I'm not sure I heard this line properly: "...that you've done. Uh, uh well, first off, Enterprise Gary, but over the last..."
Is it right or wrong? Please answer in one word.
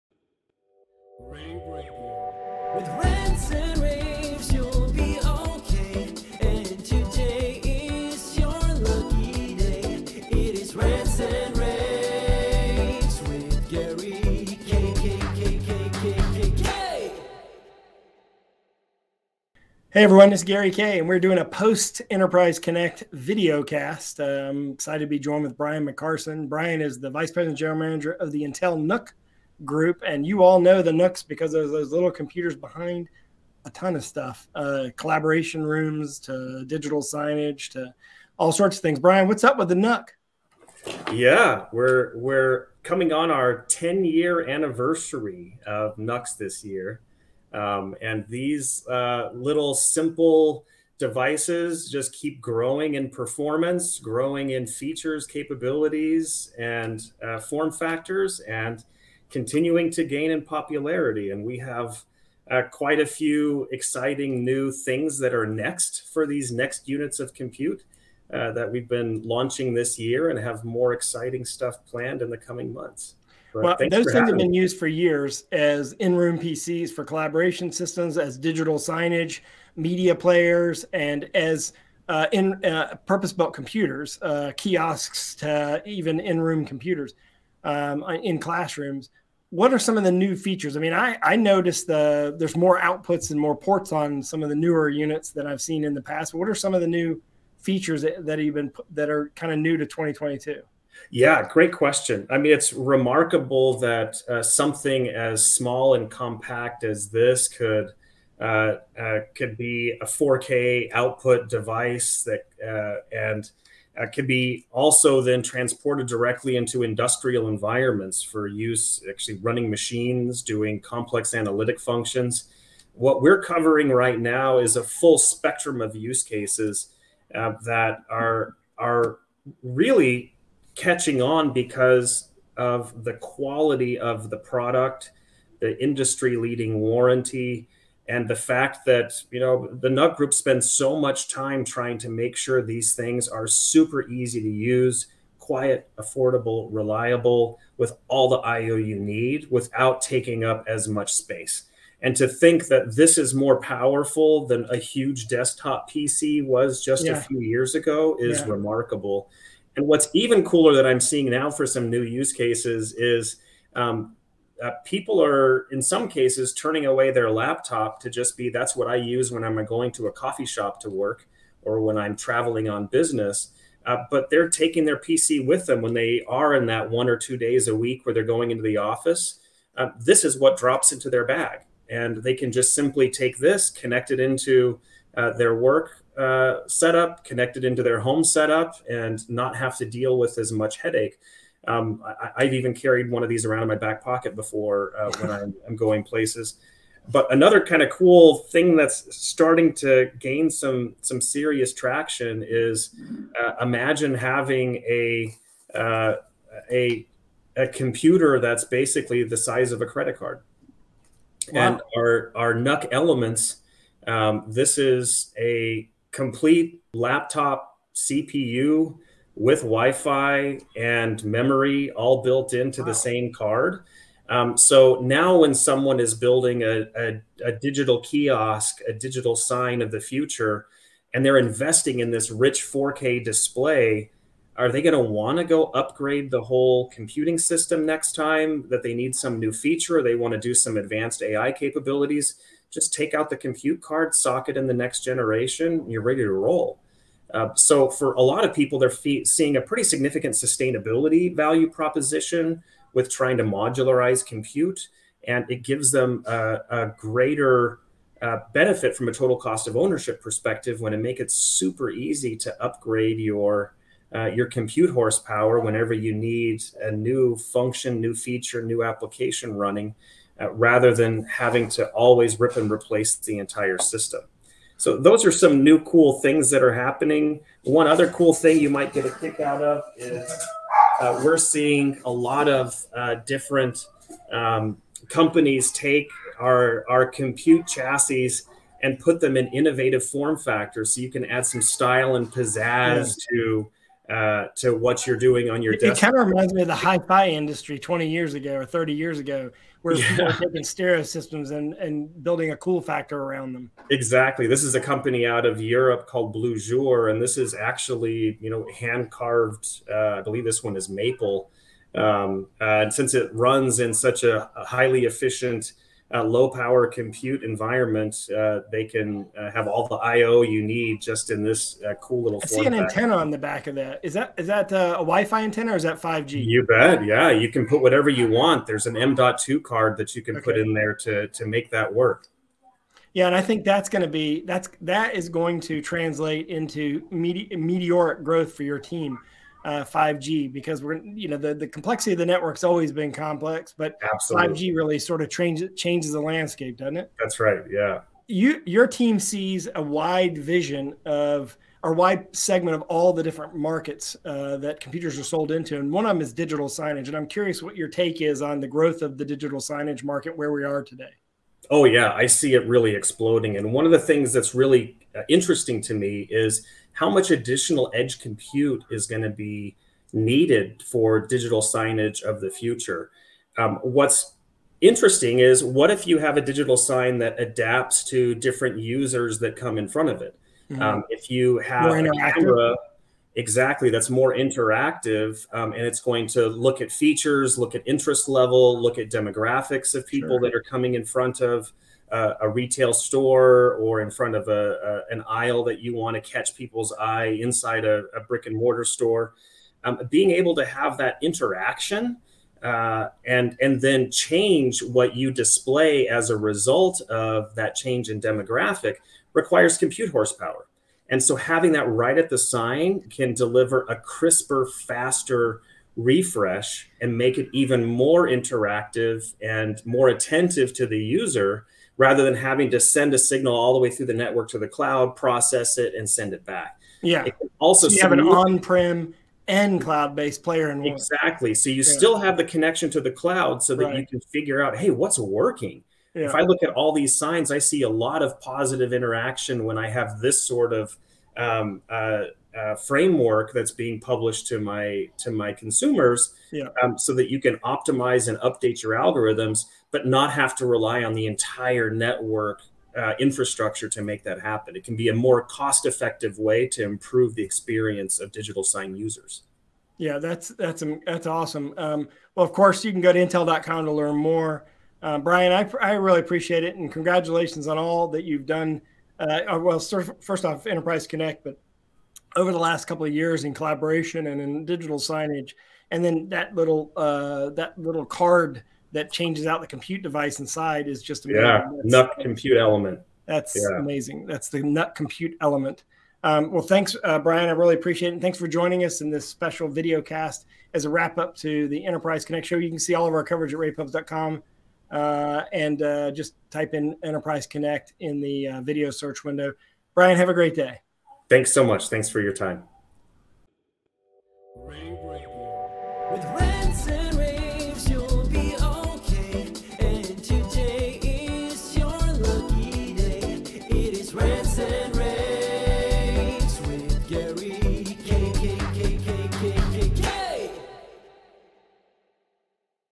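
wrong.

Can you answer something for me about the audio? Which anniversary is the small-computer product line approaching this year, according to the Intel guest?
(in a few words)
10 year.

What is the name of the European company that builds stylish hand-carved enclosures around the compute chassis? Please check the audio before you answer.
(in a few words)
Bleujour.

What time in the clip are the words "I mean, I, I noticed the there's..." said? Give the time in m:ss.
1:30.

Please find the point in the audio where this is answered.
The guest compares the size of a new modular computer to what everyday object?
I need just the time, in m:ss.
3:29.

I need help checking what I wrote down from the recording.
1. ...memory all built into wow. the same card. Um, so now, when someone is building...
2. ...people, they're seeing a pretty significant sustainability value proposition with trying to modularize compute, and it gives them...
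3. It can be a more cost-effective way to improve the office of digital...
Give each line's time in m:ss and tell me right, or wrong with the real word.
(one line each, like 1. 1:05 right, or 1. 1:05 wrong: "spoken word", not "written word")
1. 3:41 right
2. 4:08 right
3. 7:34 wrong: "experience", not "office".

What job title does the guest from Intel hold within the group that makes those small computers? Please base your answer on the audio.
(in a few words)
Vice President General Manager.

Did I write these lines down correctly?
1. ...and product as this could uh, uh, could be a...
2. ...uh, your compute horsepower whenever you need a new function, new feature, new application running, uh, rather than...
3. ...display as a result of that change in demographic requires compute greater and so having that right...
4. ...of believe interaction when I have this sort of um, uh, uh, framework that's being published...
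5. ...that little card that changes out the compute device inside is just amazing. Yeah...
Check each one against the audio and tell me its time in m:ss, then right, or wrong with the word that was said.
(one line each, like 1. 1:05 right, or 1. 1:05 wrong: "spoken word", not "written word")
1. 1:45 wrong: "compact", not "product"
2. 4:24 right
3. 6:45 wrong: "horsepower", not "greater"
4. 7:18 wrong: "positive", not "believe"
5. 7:57 right.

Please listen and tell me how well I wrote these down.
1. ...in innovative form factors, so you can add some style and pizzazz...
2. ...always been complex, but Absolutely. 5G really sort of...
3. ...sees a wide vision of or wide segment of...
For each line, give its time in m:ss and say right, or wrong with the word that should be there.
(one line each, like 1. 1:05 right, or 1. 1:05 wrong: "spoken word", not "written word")
1. 4:49 right
2. 5:42 right
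3. 5:49 right.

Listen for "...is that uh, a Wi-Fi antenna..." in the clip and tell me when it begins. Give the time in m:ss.
5:24.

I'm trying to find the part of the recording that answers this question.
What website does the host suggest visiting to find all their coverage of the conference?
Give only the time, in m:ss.
8:13.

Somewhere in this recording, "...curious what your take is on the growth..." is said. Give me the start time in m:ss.
5:57.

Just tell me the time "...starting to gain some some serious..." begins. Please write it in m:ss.
3:19.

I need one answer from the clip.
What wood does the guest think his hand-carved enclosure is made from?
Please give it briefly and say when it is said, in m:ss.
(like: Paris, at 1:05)
maple, at 5:10.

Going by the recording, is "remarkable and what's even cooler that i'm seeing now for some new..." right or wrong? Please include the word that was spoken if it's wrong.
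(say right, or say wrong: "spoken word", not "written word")
right.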